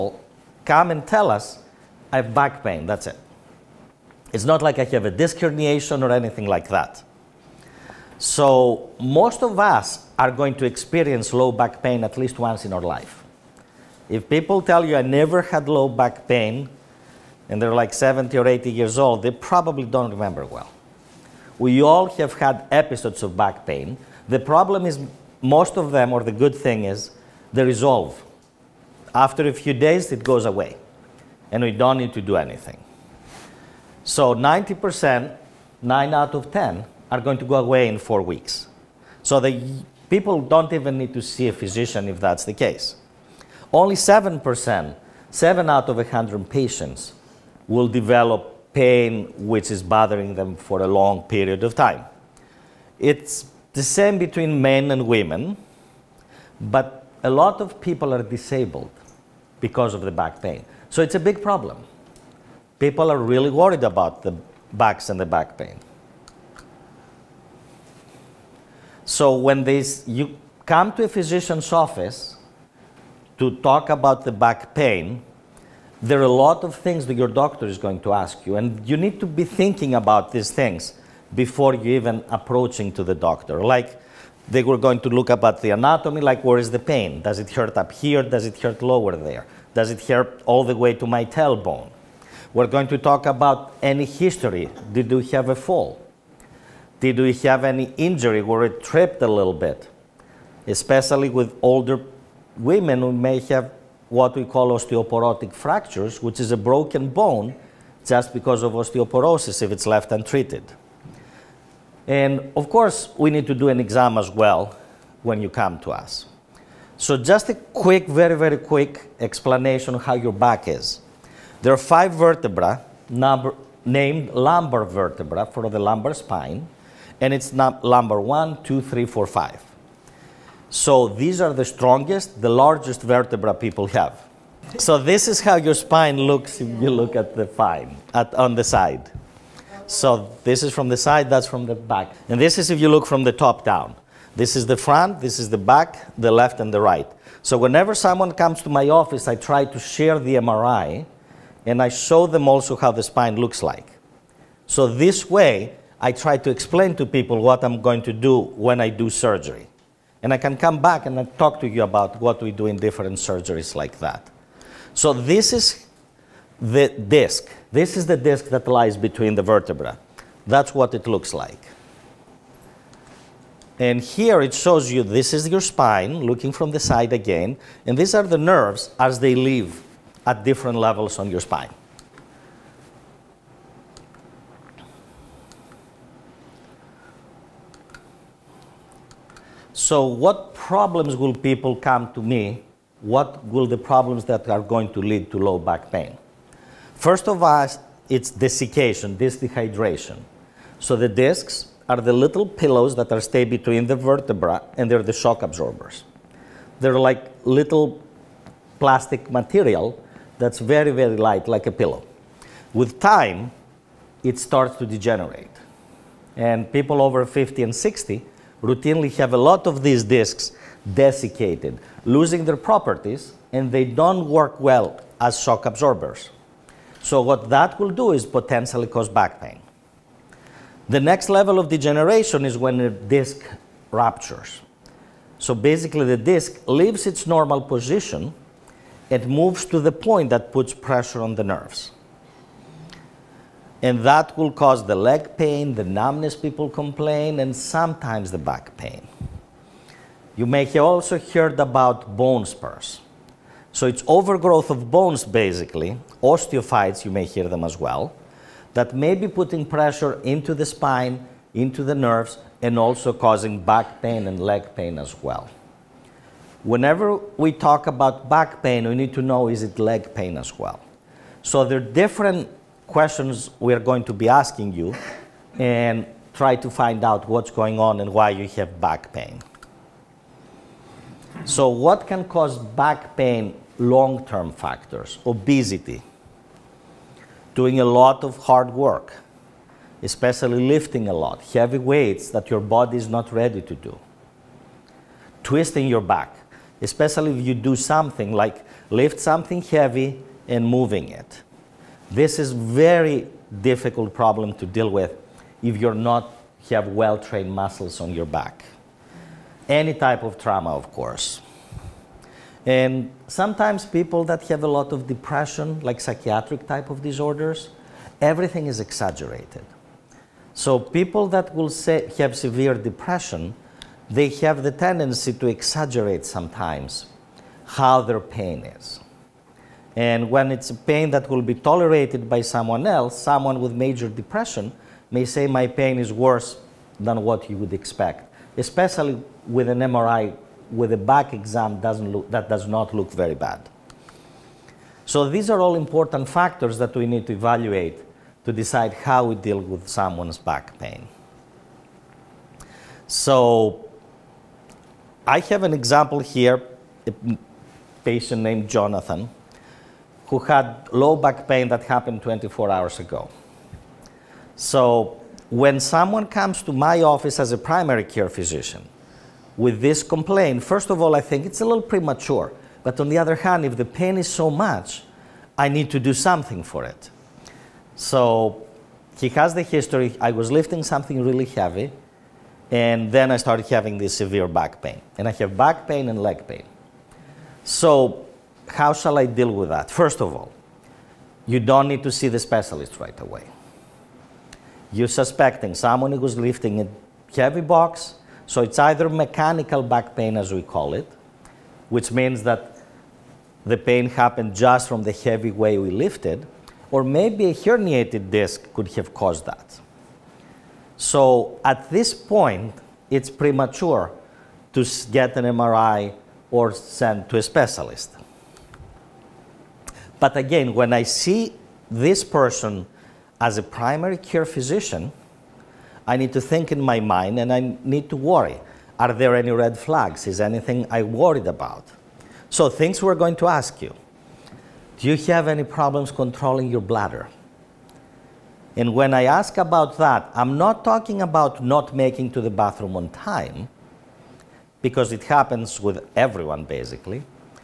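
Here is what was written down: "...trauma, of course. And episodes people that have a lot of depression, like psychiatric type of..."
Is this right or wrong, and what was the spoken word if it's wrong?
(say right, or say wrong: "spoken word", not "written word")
wrong: "sometimes", not "episodes".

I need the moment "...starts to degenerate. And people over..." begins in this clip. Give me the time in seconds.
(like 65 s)
214 s.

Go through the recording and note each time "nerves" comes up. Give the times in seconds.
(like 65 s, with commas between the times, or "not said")
178 s, 241 s, 261 s.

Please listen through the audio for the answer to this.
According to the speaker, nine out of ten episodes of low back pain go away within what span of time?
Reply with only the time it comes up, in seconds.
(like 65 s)
37 s.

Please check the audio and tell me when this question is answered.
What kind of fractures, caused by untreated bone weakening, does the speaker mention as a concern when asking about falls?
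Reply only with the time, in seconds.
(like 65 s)
104 s.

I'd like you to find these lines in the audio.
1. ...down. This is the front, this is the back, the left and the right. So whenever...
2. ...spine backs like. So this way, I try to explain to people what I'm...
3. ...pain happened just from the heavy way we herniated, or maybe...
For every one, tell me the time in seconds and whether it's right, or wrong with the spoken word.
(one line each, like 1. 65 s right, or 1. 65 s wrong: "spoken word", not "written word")
1. 143 s right
2. 153 s wrong: "looks", not "backs"
3. 403 s wrong: "lifted", not "herniated".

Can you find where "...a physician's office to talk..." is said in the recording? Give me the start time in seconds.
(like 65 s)
71 s.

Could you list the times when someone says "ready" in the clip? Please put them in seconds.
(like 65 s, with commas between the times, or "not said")
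293 s.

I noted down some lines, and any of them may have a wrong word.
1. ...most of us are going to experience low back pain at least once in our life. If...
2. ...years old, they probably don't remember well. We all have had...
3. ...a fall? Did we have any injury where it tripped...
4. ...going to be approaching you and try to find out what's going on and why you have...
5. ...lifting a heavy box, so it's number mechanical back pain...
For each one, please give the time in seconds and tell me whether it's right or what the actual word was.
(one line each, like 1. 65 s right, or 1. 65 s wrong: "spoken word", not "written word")
1. 8 s right
2. 18 s right
3. 95 s right
4. 273 s wrong: "asking", not "approaching"
5. 396 s wrong: "either", not "number".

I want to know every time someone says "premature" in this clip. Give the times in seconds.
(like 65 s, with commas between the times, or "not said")
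371 s, 413 s.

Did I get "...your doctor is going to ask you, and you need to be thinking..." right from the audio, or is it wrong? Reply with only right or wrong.
right.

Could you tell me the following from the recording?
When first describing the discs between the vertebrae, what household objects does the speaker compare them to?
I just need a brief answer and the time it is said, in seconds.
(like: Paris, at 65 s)
little pillows, at 202 s.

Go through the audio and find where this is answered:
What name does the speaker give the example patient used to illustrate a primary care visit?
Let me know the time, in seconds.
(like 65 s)
358 s.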